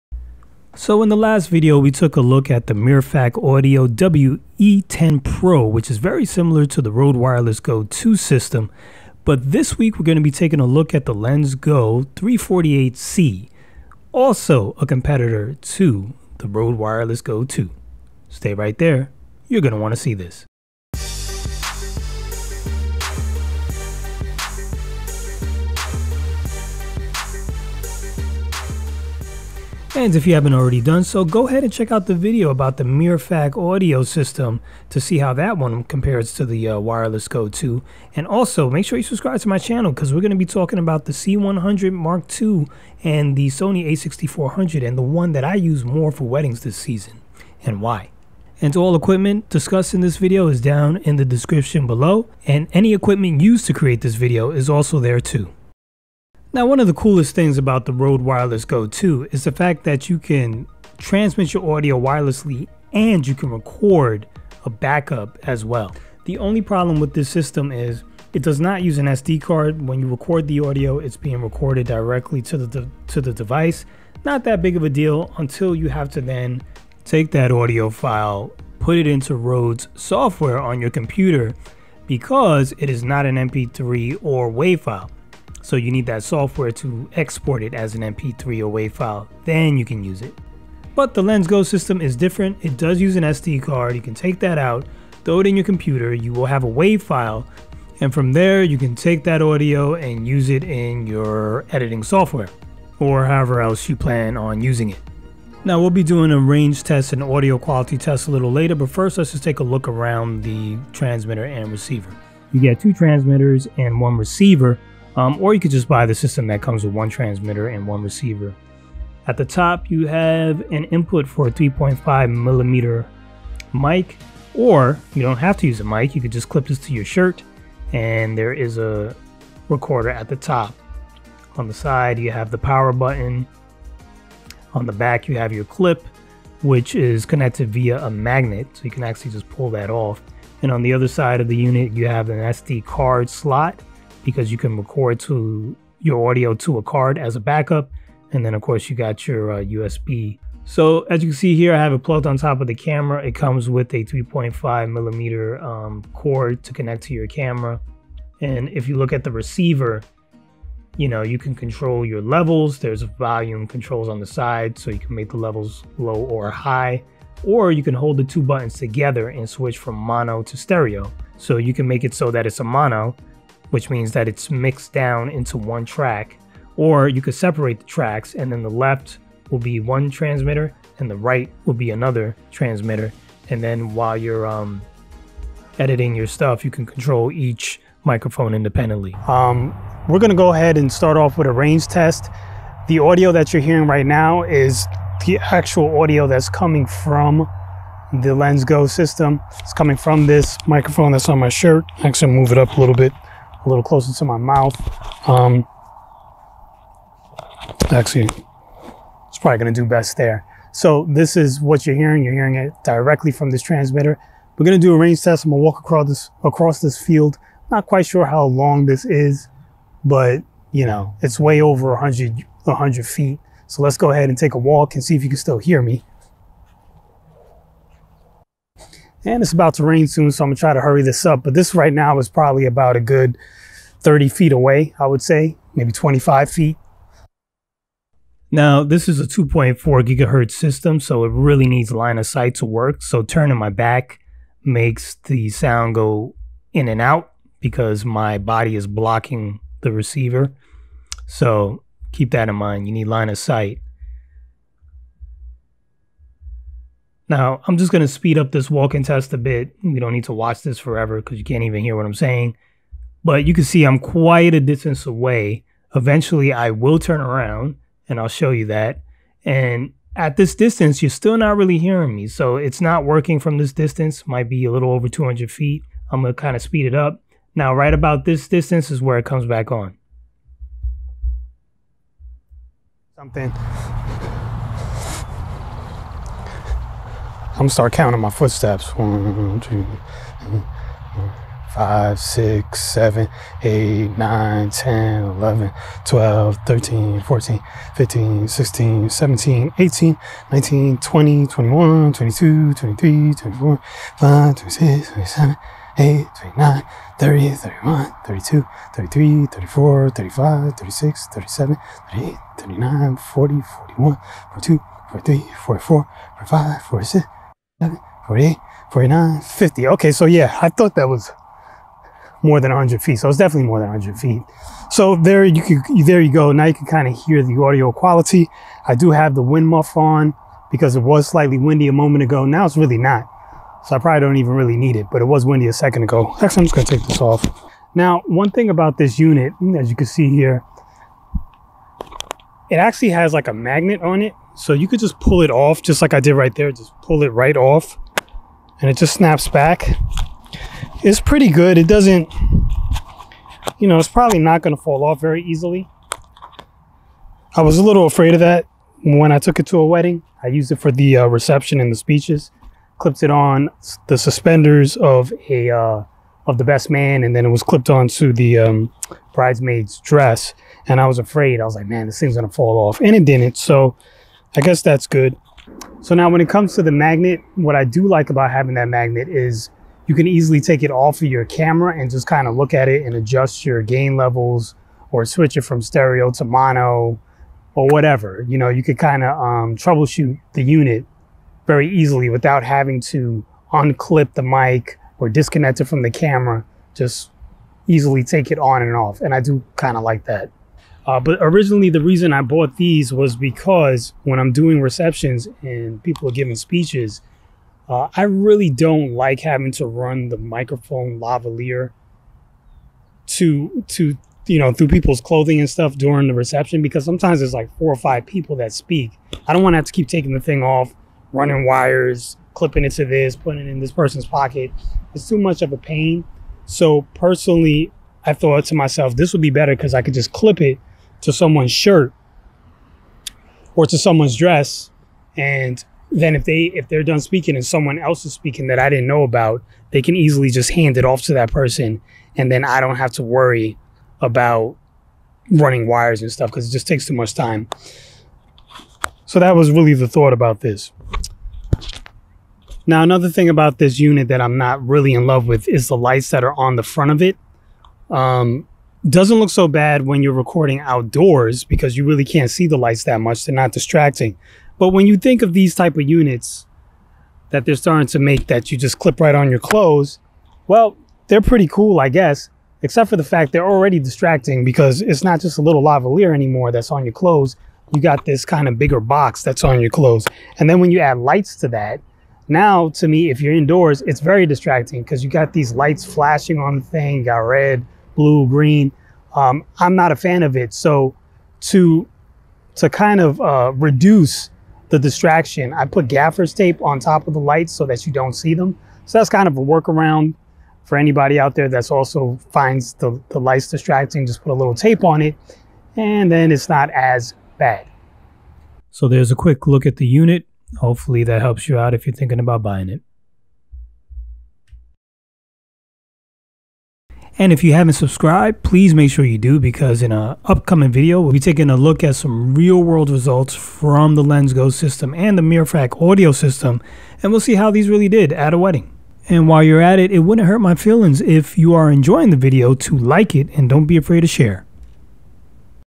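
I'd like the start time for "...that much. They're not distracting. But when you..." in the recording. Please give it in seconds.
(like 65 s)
463 s.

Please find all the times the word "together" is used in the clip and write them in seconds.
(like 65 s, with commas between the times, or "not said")
168 s.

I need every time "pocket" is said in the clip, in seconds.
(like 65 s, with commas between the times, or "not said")
424 s.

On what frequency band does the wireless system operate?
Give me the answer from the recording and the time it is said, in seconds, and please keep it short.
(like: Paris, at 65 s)
2.4 gigahertz, at 239 s.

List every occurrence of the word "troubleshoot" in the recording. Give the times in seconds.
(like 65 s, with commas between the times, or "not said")
389 s.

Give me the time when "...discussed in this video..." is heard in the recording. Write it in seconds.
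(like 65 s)
49 s.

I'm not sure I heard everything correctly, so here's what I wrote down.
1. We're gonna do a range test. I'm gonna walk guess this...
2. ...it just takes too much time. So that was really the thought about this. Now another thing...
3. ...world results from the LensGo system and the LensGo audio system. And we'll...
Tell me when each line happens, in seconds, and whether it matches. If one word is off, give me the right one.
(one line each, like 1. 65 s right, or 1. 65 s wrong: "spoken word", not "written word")
1. 214 s wrong: "across", not "guess"
2. 446 s right
3. 522 s wrong: "Mirfak", not "LensGo".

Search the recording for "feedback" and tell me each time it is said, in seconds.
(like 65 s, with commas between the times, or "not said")
not said.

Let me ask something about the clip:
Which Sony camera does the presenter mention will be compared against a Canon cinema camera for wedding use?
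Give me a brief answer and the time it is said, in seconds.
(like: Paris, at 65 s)
a6400, at 43 s.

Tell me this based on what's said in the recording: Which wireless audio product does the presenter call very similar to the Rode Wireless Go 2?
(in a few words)
Mirfak Audio WE10 Pro.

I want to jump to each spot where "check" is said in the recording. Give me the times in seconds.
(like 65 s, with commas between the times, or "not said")
31 s.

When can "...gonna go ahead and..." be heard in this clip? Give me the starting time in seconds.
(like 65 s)
190 s.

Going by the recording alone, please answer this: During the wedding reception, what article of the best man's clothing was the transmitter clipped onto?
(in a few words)
suspenders.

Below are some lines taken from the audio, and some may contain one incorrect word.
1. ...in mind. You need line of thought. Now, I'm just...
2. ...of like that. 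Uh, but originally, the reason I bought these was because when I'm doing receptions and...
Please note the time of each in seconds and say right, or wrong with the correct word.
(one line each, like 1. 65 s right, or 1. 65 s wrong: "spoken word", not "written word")
1. 252 s wrong: "sight", not "thought"
2. 399 s right.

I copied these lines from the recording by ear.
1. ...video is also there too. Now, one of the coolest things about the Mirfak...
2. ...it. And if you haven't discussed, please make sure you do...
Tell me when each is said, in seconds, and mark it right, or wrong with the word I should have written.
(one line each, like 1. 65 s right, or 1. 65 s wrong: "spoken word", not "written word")
1. 54 s wrong: "Rode", not "Mirfak"
2. 512 s wrong: "subscribed", not "discussed".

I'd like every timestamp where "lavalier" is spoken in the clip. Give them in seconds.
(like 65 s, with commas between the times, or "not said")
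411 s, 475 s.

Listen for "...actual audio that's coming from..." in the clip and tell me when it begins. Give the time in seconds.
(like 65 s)
195 s.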